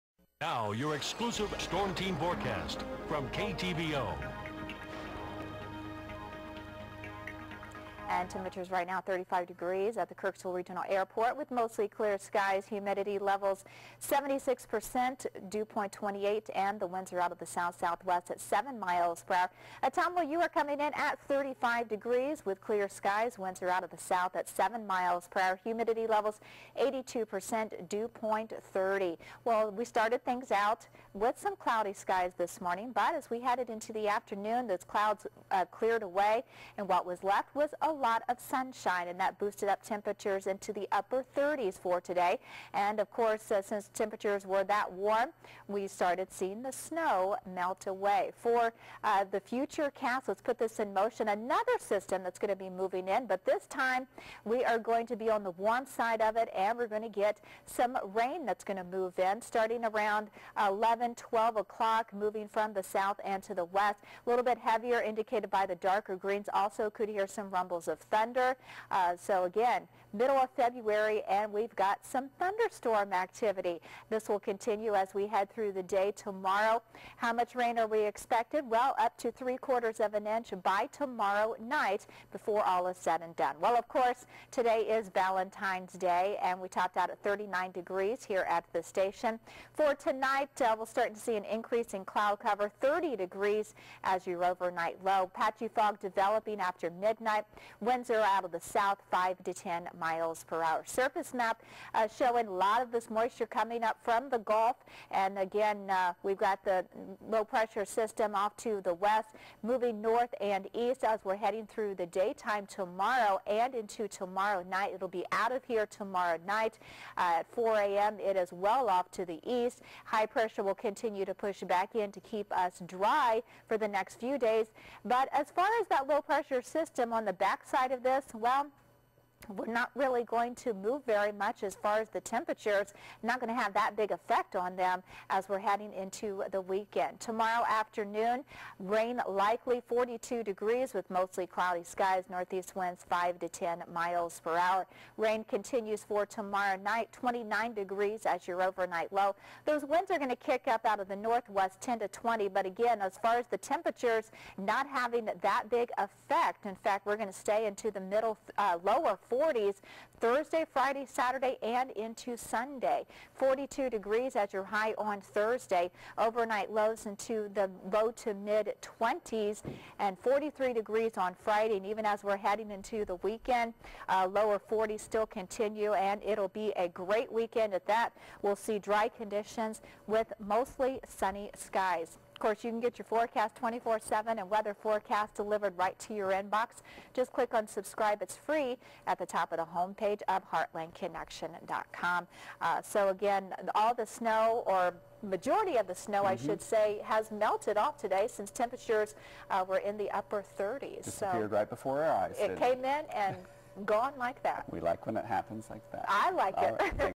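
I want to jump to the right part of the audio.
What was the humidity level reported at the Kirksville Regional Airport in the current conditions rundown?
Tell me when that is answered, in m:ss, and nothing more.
0:14.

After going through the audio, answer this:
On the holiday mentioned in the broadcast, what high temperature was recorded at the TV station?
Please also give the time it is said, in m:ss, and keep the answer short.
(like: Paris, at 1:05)
39 degrees, at 1:27.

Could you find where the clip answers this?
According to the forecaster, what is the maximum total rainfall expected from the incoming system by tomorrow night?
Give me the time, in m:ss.
1:19.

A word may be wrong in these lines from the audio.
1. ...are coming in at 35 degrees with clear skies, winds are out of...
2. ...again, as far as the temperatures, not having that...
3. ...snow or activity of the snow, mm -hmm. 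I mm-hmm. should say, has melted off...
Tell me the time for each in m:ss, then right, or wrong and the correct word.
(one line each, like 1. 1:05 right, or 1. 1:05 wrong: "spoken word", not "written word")
1. 0:20 right
2. 2:32 right
3. 3:14 wrong: "majority", not "activity".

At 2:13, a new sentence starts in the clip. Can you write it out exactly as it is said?
Not going to have that big effect on them as we're heading into the weekend.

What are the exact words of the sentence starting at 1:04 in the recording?
A little bit heavier, indicated by the darker greens.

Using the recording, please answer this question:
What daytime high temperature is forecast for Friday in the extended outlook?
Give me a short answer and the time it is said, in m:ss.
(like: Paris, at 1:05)
43 degrees, at 2:50.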